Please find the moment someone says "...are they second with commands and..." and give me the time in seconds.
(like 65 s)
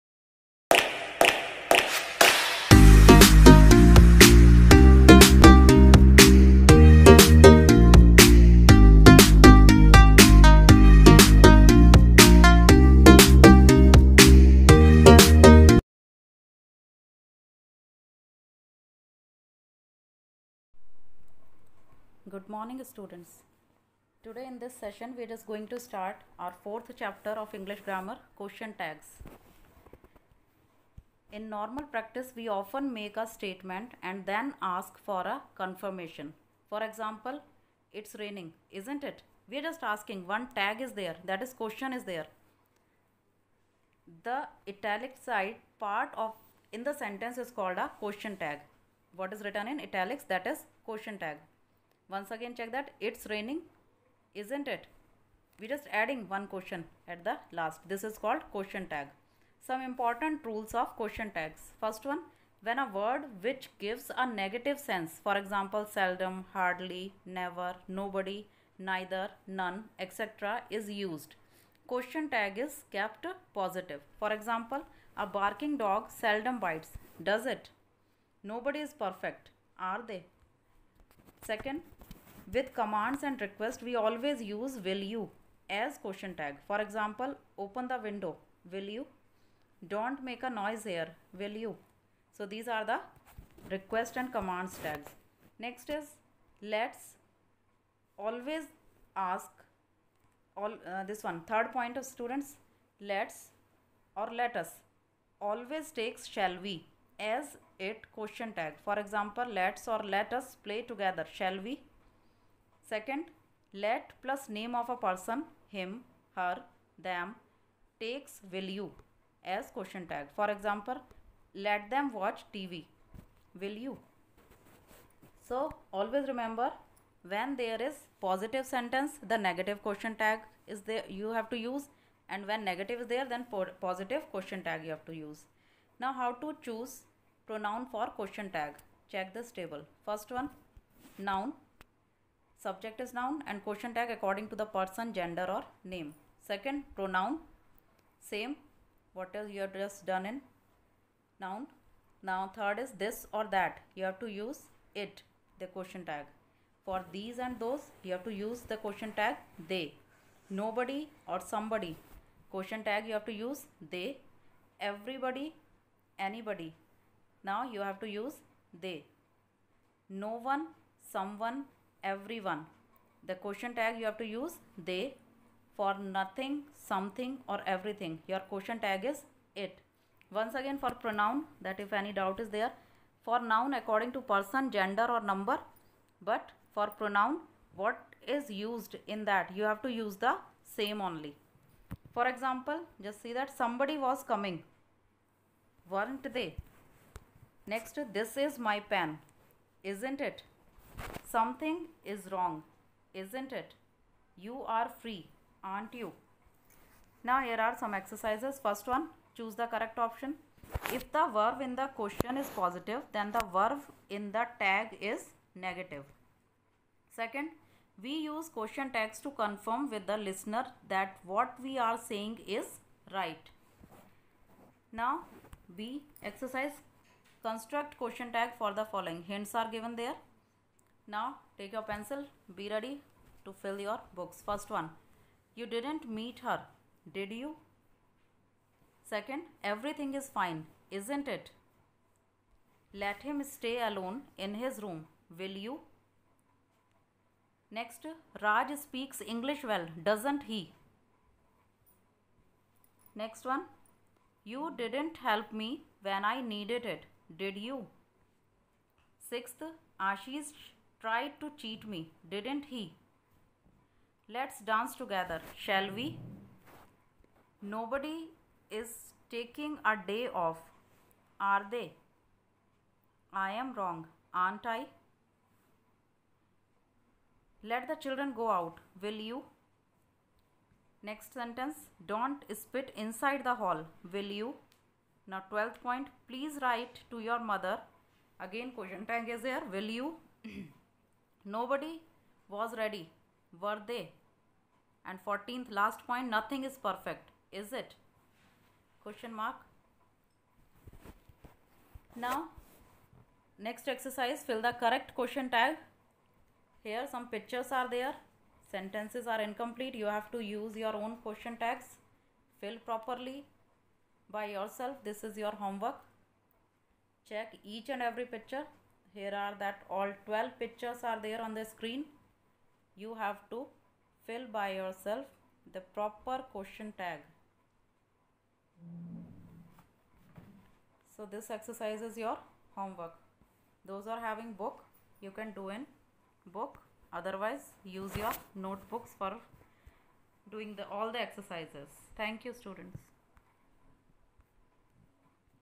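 79 s.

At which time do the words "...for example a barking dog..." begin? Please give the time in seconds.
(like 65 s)
74 s.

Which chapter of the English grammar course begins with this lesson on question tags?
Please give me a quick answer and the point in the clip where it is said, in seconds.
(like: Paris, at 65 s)
4, at 26 s.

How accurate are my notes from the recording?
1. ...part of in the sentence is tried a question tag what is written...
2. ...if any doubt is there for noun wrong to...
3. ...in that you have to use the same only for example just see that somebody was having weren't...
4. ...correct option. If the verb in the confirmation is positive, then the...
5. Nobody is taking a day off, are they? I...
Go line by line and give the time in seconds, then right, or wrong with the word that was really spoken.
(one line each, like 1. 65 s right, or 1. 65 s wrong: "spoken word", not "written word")
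1. 45 s wrong: "called", not "tried"
2. 181 s wrong: "according", not "wrong"
3. 189 s wrong: "coming", not "having"
4. 209 s wrong: "question", not "confirmation"
5. 267 s right.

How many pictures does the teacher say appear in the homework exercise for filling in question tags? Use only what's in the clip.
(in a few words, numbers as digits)
12.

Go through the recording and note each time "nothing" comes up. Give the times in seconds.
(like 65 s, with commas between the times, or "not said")
176 s, 296 s.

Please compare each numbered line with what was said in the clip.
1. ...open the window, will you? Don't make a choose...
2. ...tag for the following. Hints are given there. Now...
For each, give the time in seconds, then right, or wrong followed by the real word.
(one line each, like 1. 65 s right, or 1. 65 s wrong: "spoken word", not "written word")
1. 87 s wrong: "noise", not "choose"
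2. 228 s right.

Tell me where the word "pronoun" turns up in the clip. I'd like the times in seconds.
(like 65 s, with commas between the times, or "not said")
137 s, 146 s, 181 s, 187 s.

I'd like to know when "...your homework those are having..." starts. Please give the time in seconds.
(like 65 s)
332 s.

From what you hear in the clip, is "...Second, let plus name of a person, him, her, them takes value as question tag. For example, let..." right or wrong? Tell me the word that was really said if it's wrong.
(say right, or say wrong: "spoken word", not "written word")
right.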